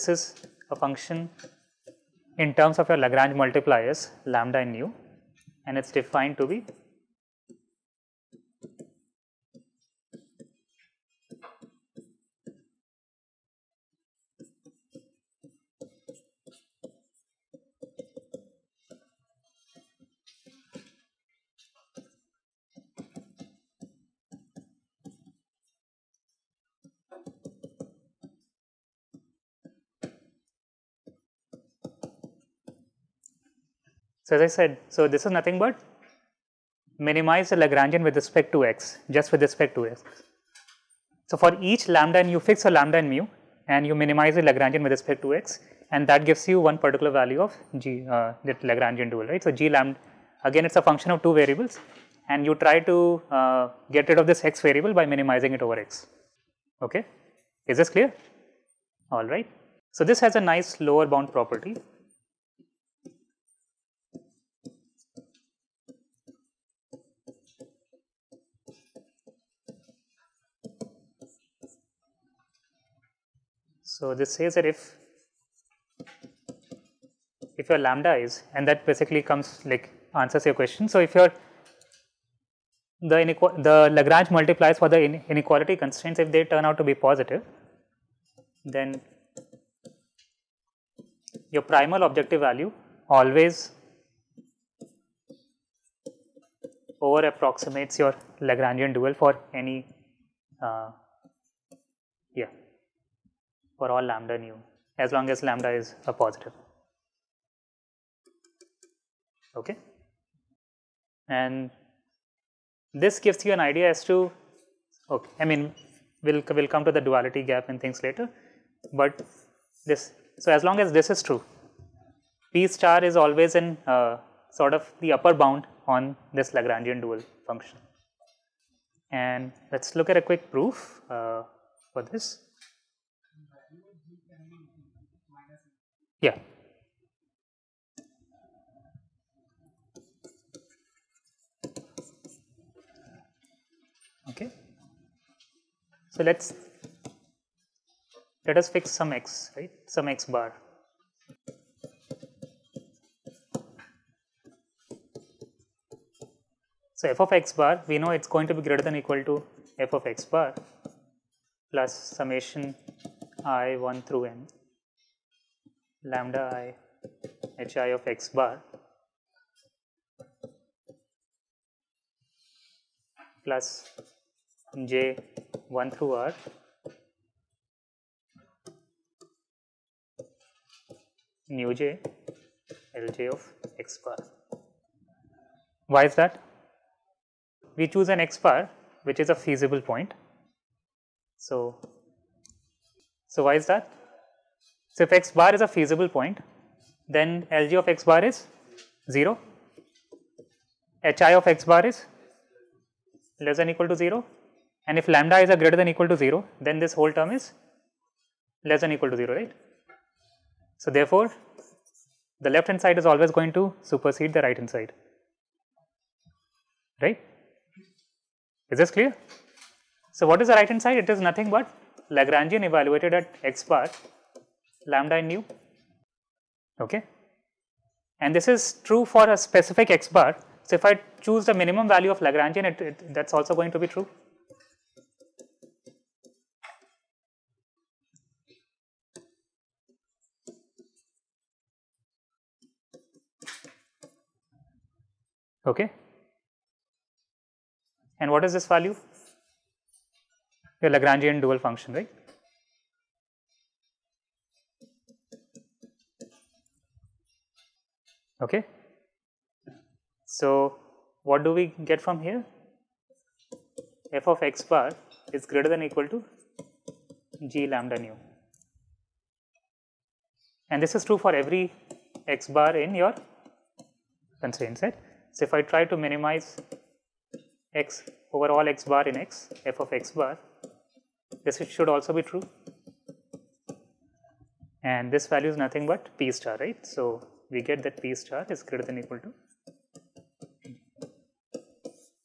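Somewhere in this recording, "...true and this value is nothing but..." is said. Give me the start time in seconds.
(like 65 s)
282 s.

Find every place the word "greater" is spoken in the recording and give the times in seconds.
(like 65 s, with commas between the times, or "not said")
158 s, 205 s, 265 s, 288 s.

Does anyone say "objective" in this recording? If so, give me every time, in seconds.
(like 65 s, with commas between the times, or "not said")
92 s.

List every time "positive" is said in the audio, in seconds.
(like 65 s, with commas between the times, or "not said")
87 s, 106 s.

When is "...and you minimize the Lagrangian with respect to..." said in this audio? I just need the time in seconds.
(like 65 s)
43 s.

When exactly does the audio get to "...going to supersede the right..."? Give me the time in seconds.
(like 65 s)
213 s.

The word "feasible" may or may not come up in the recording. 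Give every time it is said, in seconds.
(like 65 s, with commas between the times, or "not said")
189 s, 195 s.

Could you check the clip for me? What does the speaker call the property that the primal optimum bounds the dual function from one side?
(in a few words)
lower bound property.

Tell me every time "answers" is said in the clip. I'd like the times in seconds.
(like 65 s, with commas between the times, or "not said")
80 s.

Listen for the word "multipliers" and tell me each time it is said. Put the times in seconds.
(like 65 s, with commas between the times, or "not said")
3 s, 84 s.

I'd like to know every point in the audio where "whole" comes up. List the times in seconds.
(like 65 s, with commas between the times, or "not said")
206 s.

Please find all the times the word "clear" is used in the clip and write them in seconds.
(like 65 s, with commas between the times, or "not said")
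57 s, 218 s.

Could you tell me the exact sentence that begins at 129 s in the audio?
And let's look at a quick proof uh, for this.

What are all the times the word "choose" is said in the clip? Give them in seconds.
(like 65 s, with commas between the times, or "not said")
187 s, 231 s.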